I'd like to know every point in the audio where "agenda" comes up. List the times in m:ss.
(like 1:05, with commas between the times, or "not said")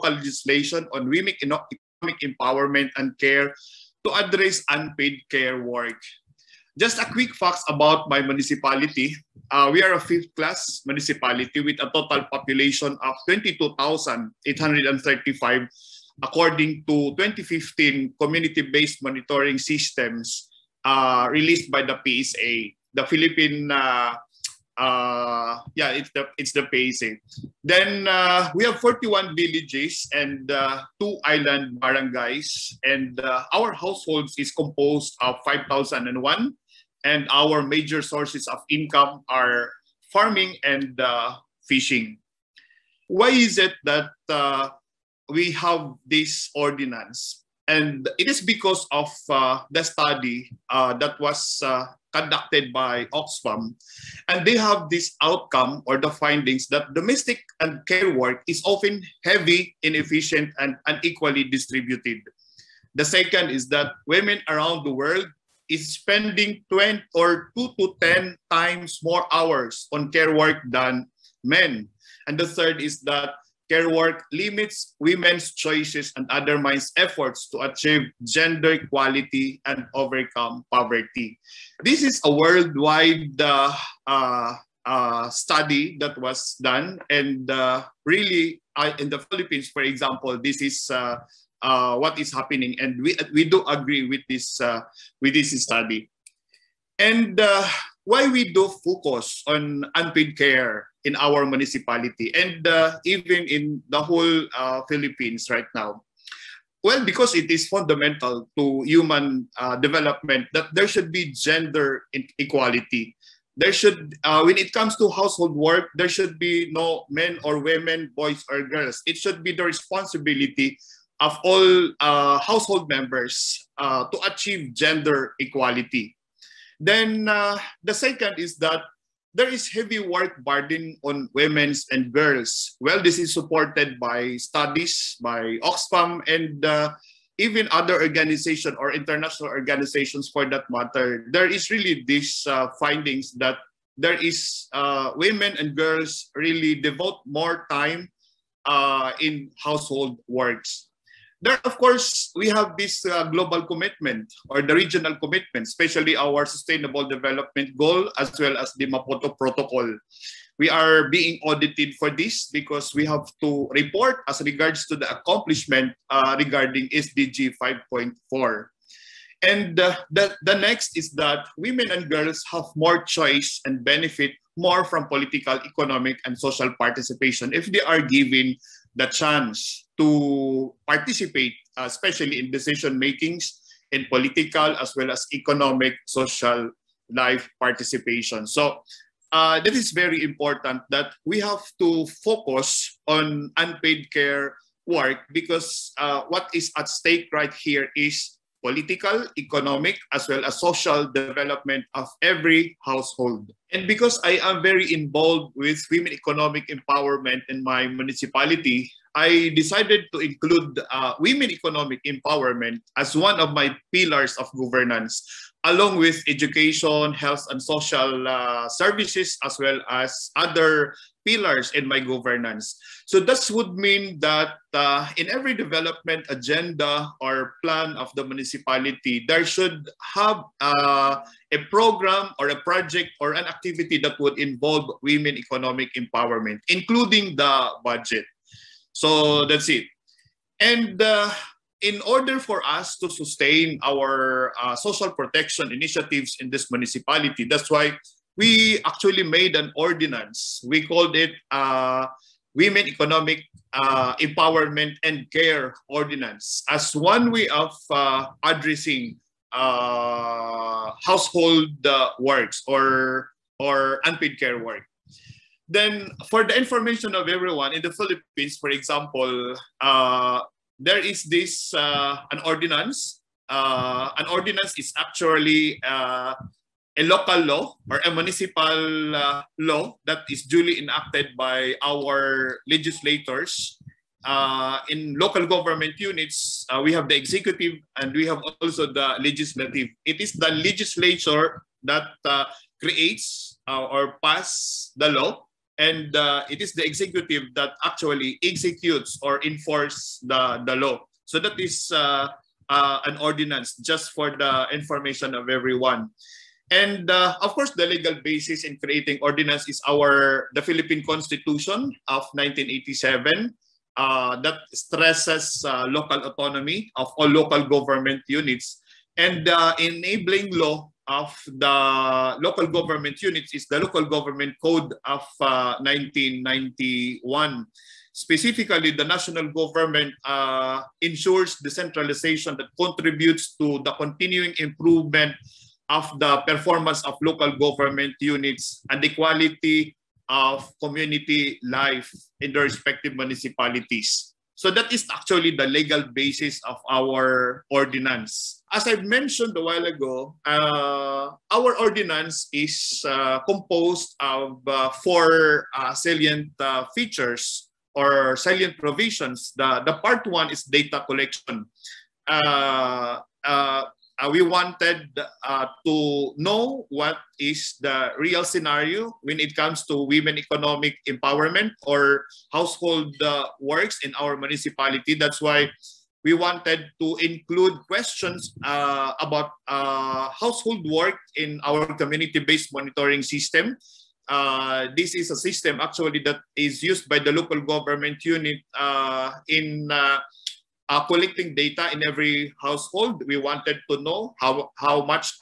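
3:46.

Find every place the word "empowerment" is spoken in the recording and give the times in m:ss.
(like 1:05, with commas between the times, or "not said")
0:02, 3:26, 3:32, 3:56, 4:14, 6:11.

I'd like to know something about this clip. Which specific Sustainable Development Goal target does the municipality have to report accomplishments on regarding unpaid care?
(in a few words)
SDG 5.4.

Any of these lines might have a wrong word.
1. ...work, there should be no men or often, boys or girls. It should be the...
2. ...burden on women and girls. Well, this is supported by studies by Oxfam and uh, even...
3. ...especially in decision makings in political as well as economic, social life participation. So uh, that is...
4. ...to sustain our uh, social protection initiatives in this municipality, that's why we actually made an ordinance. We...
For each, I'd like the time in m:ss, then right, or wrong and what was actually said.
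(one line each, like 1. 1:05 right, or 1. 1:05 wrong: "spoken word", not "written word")
1. 1:55 wrong: "women", not "often"
2. 2:10 right
3. 3:01 right
4. 4:02 right.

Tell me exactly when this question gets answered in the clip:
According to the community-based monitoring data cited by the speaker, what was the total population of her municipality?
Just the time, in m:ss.
0:13.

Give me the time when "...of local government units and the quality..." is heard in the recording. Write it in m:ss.
5:37.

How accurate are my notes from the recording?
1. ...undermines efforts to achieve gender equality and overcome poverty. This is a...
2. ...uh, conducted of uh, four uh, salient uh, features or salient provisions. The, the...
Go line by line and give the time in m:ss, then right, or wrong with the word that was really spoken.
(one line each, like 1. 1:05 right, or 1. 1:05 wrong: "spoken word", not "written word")
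1. 1:16 right
2. 5:53 wrong: "composed", not "conducted".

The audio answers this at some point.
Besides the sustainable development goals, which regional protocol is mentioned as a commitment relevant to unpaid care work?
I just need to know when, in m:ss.
2:38.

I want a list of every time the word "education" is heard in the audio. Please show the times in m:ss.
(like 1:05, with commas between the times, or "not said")
3:36.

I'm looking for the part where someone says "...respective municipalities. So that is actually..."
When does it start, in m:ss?
5:42.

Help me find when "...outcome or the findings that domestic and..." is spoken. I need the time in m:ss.
0:55.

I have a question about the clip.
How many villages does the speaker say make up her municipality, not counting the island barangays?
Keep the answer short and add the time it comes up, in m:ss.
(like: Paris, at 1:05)
41, at 0:28.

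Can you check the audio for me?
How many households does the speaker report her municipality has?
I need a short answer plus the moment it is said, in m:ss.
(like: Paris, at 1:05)
5,001, at 0:35.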